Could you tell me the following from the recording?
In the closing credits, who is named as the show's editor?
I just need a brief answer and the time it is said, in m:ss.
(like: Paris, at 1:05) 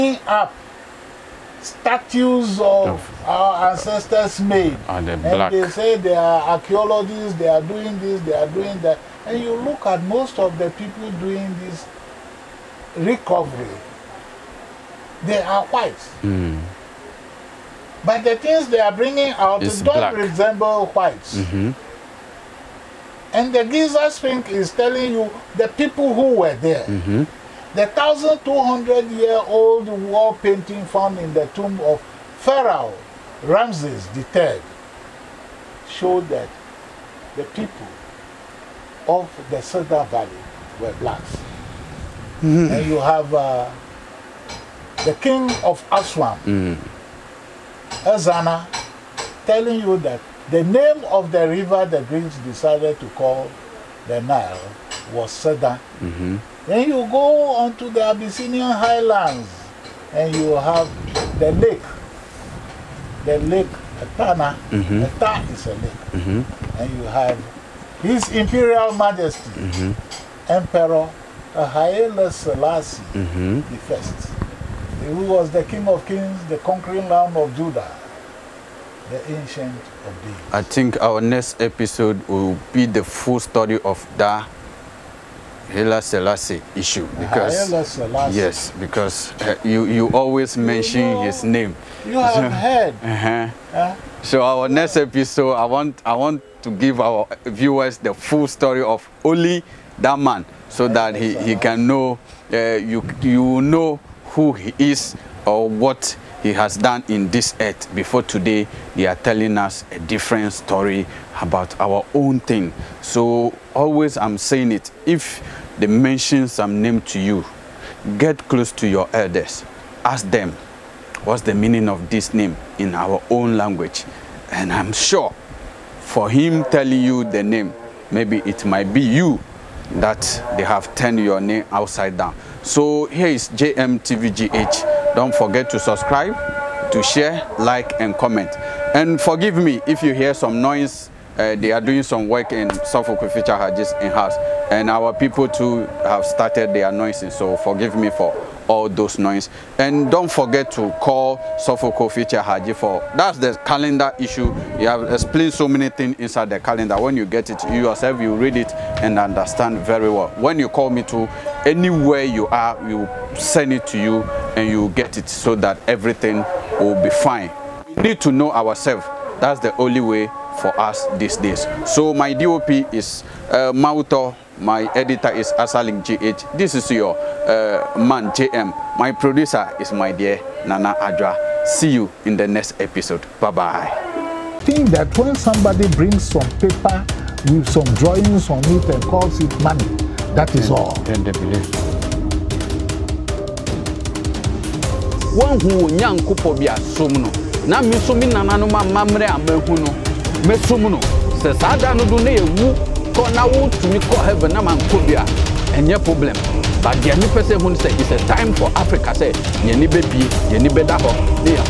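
Asaling GH, at 2:55.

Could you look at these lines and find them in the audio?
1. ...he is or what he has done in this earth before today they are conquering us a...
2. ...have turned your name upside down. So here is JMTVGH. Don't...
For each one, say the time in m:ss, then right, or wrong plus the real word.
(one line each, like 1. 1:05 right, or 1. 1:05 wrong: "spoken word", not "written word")
1. 1:44 wrong: "telling", not "conquering"
2. 2:10 right.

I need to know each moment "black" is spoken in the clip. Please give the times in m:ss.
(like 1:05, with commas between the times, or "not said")
0:19, 0:41.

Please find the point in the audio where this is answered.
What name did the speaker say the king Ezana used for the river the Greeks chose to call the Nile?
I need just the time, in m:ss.
0:55.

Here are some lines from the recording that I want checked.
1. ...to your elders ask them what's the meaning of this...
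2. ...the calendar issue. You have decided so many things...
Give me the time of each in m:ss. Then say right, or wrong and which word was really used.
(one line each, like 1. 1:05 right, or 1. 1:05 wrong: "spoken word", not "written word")
1. 1:58 right
2. 2:33 wrong: "explained", not "decided".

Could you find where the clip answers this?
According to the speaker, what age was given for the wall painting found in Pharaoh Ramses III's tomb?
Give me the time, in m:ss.
0:27.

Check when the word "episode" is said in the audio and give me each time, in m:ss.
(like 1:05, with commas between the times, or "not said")
1:21, 1:34, 3:02.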